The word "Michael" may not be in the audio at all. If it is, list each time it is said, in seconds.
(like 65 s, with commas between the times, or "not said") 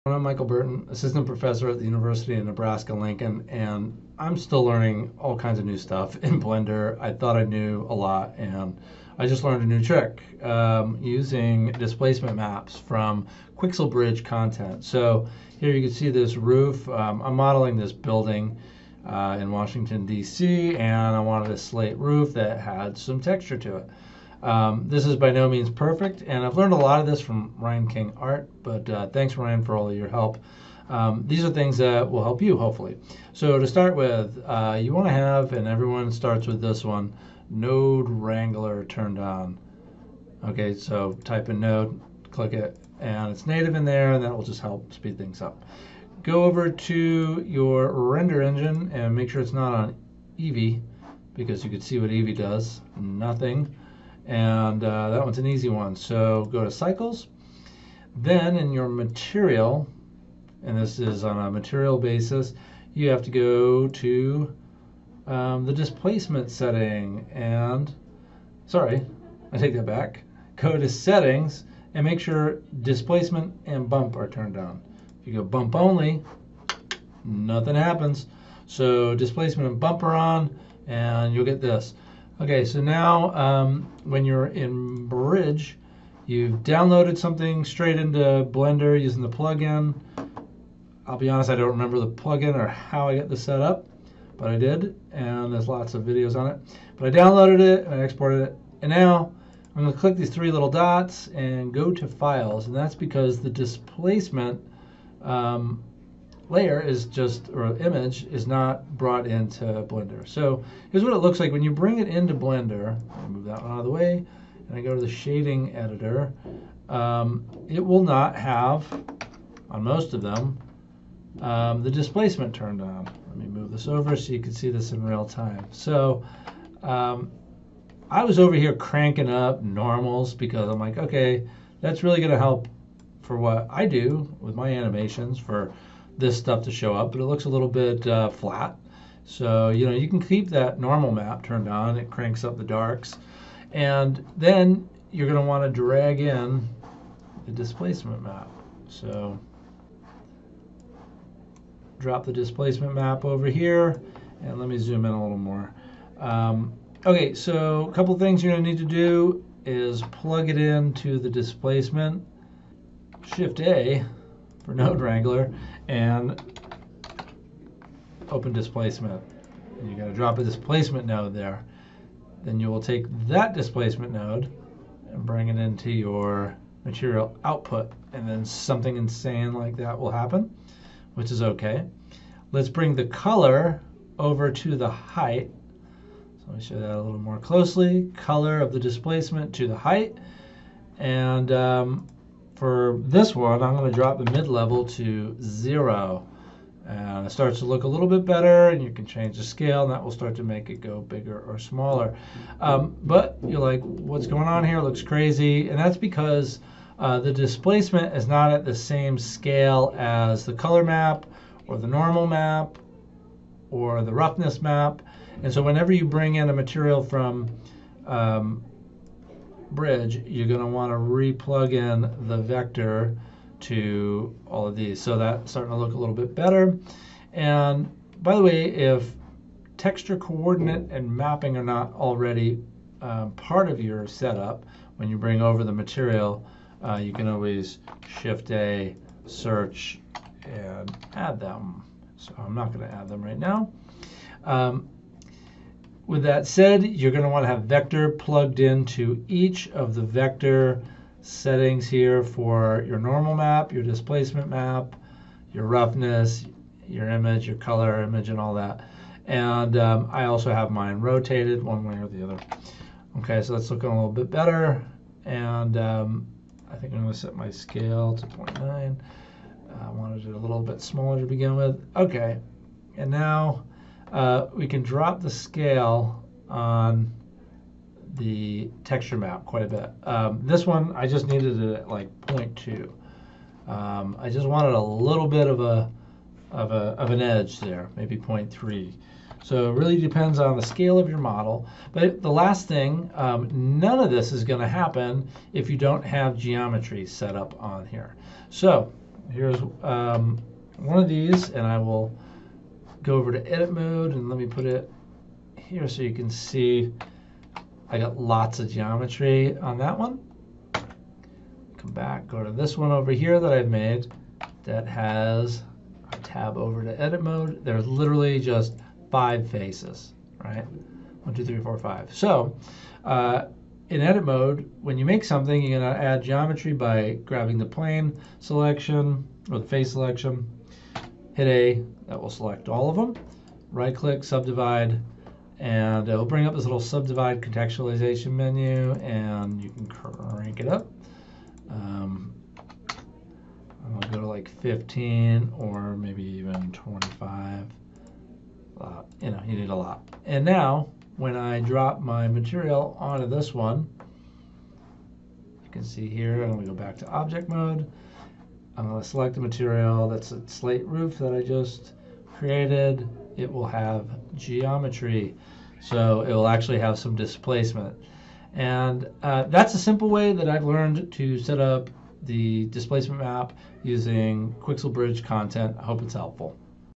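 0 s.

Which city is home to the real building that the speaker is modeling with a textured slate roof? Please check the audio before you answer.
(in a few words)
Washington, D.C.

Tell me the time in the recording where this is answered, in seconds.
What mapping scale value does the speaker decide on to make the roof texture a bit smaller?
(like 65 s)
268 s.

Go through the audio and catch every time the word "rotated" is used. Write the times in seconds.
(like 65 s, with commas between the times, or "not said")
260 s.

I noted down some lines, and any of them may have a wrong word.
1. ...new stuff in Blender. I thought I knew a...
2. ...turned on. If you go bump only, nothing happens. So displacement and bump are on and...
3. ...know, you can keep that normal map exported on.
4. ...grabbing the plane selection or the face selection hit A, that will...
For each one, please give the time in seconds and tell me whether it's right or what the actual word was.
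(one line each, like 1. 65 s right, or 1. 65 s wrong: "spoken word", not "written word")
1. 5 s right
2. 74 s right
3. 139 s wrong: "turned", not "exported"
4. 327 s right.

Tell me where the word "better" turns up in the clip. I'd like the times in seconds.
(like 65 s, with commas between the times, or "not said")
198 s, 226 s, 264 s.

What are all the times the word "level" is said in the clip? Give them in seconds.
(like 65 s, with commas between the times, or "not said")
194 s.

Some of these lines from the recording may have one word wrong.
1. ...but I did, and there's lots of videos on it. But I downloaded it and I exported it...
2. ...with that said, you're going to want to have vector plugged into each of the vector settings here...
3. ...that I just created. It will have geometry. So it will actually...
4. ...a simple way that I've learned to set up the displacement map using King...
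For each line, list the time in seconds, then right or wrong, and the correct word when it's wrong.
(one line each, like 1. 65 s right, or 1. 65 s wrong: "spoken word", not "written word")
1. 94 s right
2. 246 s right
3. 361 s right
4. 369 s wrong: "Quixel", not "King".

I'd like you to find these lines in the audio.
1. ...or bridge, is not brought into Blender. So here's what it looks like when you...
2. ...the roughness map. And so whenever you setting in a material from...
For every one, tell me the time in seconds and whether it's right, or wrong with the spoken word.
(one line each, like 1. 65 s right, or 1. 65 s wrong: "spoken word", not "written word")
1. 107 s wrong: "image", not "bridge"
2. 214 s wrong: "bring", not "setting".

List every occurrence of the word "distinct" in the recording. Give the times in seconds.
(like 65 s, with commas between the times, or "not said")
not said.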